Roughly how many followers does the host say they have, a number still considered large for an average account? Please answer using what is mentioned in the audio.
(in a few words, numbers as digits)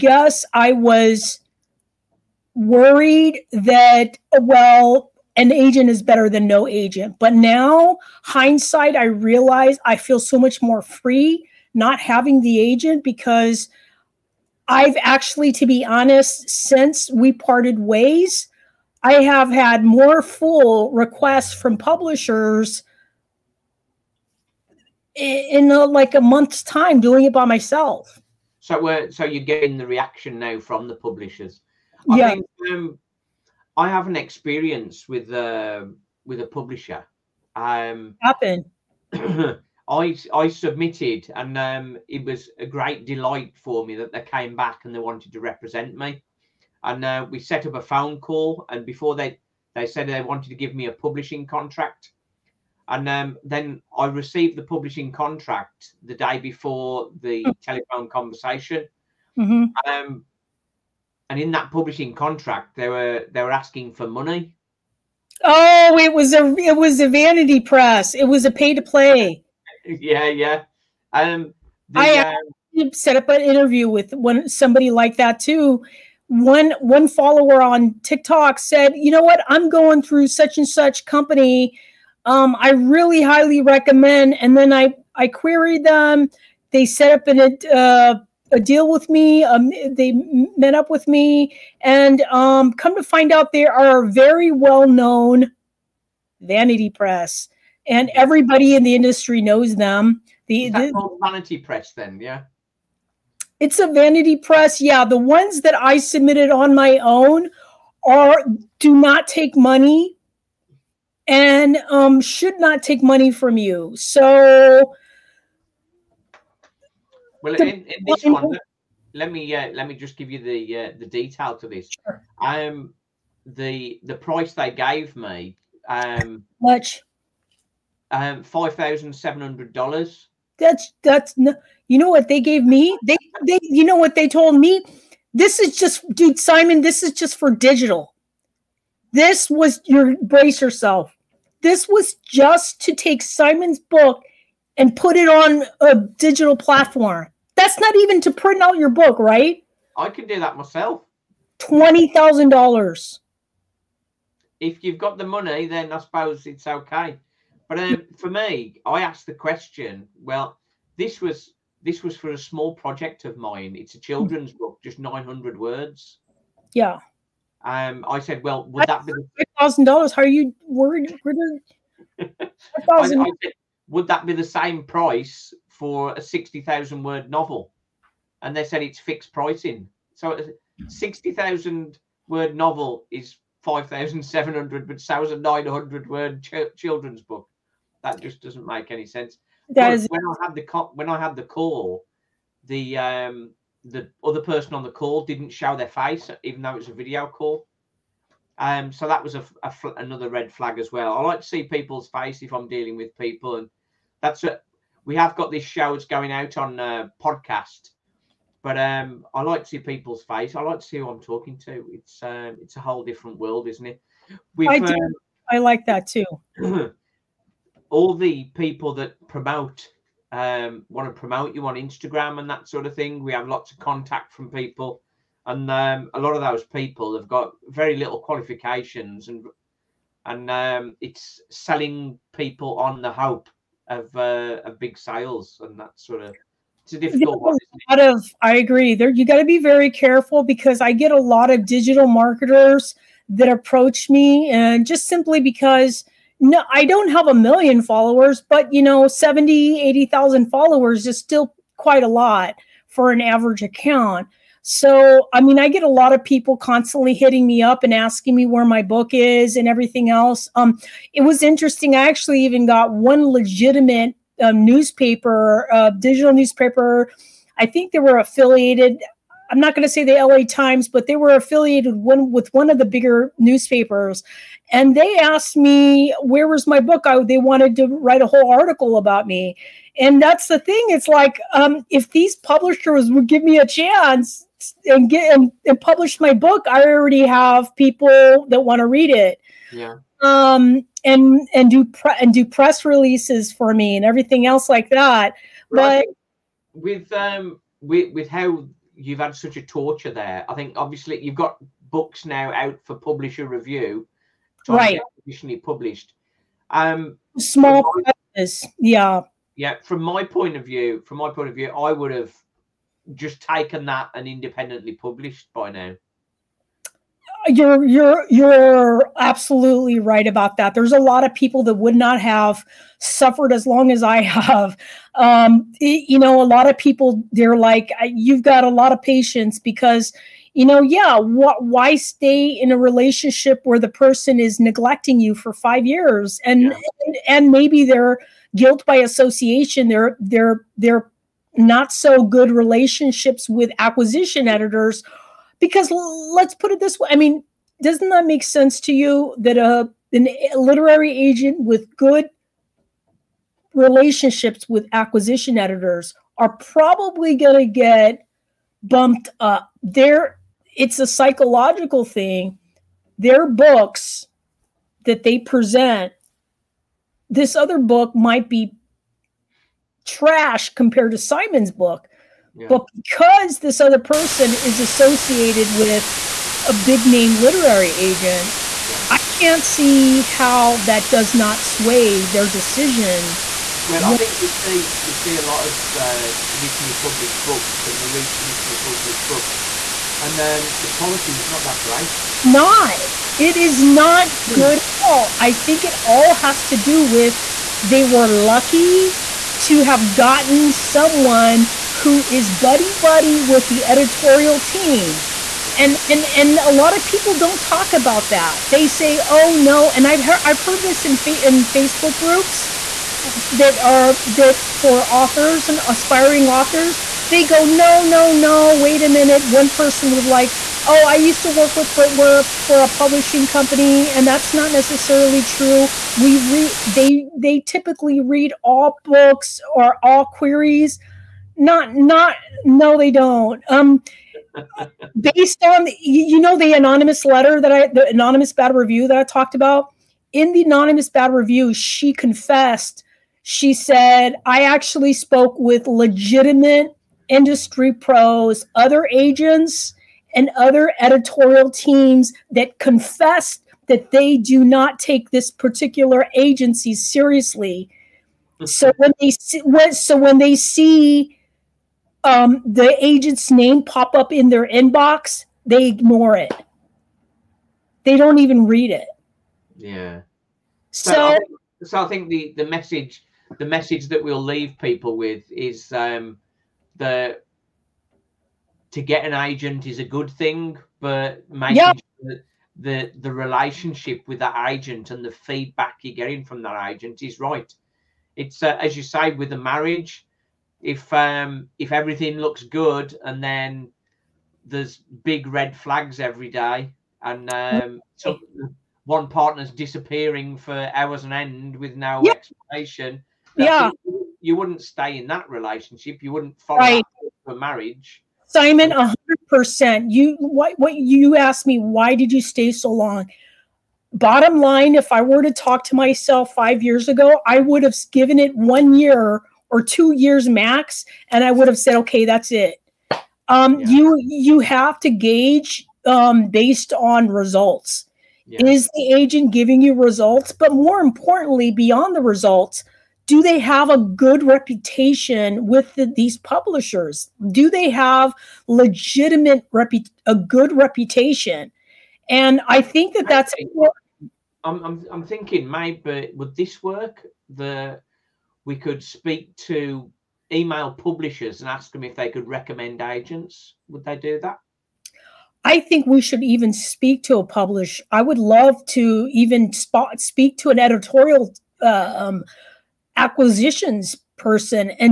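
70,000 to 80,000.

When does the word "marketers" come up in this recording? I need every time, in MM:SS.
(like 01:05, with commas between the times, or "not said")
04:02.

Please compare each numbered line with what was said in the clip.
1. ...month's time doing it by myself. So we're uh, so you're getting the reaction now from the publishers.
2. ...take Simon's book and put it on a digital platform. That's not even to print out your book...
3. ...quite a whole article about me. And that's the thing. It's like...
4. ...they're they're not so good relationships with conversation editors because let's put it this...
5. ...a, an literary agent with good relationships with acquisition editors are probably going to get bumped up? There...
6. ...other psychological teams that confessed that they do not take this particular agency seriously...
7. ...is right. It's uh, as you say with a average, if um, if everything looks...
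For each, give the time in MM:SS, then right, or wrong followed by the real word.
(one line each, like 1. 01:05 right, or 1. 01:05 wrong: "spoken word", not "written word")
1. 00:26 right
2. 02:22 right
3. 04:37 wrong: "write", not "quite"
4. 05:40 wrong: "acquisition", not "conversation"
5. 05:50 right
6. 07:30 wrong: "editorial", not "psychological"
7. 08:07 wrong: "marriage", not "average".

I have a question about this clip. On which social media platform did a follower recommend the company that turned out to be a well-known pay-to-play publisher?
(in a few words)
TikTok.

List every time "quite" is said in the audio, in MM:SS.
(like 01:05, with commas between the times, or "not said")
04:11.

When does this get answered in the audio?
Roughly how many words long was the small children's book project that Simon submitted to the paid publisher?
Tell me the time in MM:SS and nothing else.
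02:44.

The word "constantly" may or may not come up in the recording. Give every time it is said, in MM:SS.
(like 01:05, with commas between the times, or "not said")
04:16.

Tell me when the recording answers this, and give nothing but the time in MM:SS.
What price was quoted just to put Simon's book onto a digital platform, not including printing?
02:08.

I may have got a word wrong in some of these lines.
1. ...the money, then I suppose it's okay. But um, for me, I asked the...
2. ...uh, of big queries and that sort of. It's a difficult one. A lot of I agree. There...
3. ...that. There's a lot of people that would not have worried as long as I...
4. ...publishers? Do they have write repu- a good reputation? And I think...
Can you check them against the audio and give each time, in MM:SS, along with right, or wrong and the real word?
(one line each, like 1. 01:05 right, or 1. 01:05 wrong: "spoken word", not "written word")
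1. 02:35 right
2. 03:54 wrong: "sales", not "queries"
3. 05:20 wrong: "suffered", not "worried"
4. 08:56 wrong: "legitimate", not "write".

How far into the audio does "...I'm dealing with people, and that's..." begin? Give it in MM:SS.
03:22.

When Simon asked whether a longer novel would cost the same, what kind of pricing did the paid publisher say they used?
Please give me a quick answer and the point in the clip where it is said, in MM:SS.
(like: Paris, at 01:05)
Fixed pricing, at 02:58.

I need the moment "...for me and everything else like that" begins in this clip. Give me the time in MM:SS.
04:53.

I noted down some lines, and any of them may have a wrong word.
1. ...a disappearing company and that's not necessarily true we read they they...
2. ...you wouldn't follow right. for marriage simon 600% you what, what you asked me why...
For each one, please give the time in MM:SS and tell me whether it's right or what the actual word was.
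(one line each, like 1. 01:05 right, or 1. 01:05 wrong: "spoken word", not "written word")
1. 07:02 wrong: "publishing", not "disappearing"
2. 08:26 wrong: "100", not "600".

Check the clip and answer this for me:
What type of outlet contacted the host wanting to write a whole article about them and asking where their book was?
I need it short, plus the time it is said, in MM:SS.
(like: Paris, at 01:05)
Digital newspaper, at 04:25.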